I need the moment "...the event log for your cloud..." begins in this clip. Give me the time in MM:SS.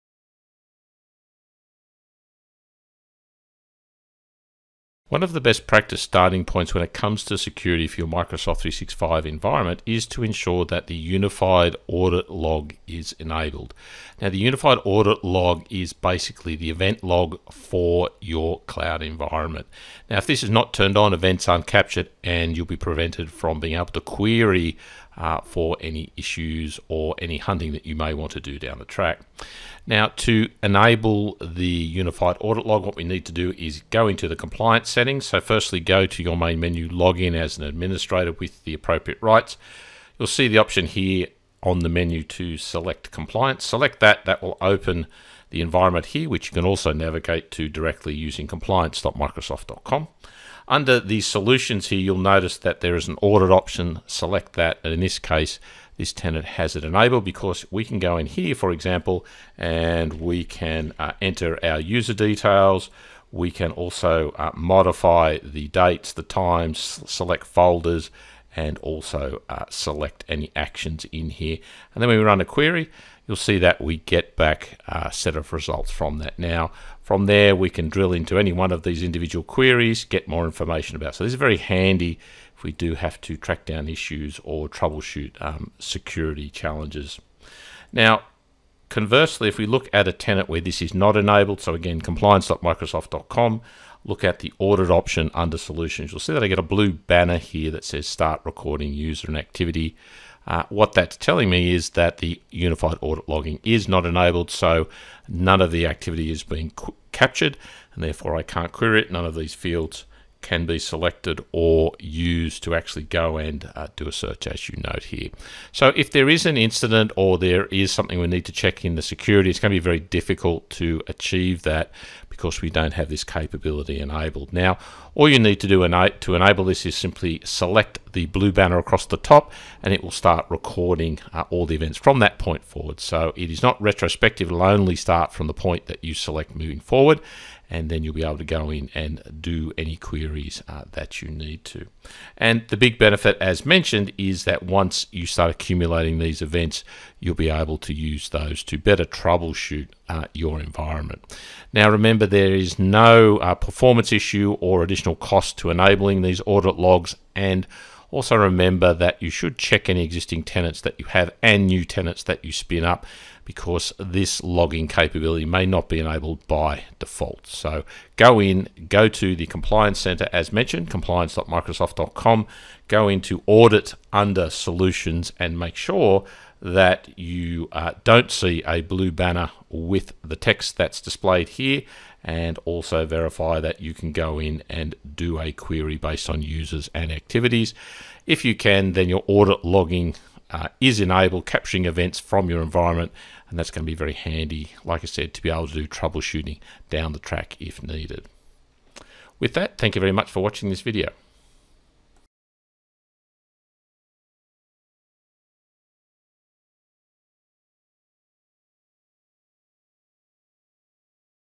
00:16.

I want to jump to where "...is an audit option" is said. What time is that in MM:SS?
00:52.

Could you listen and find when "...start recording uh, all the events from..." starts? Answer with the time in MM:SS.
02:10.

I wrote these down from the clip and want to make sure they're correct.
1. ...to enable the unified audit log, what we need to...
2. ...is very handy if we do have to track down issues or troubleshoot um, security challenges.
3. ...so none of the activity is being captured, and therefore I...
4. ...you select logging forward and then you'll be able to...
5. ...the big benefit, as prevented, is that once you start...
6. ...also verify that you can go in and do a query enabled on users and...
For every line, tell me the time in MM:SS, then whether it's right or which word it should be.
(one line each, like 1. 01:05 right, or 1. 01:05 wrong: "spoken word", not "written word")
1. 00:30 right
2. 01:21 right
3. 01:44 right
4. 02:16 wrong: "moving", not "logging"
5. 02:22 wrong: "mentioned", not "prevented"
6. 03:02 wrong: "based", not "enabled".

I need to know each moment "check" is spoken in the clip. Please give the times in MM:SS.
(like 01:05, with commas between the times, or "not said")
01:58, 02:39.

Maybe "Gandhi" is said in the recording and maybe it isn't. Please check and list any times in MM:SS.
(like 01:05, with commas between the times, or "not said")
not said.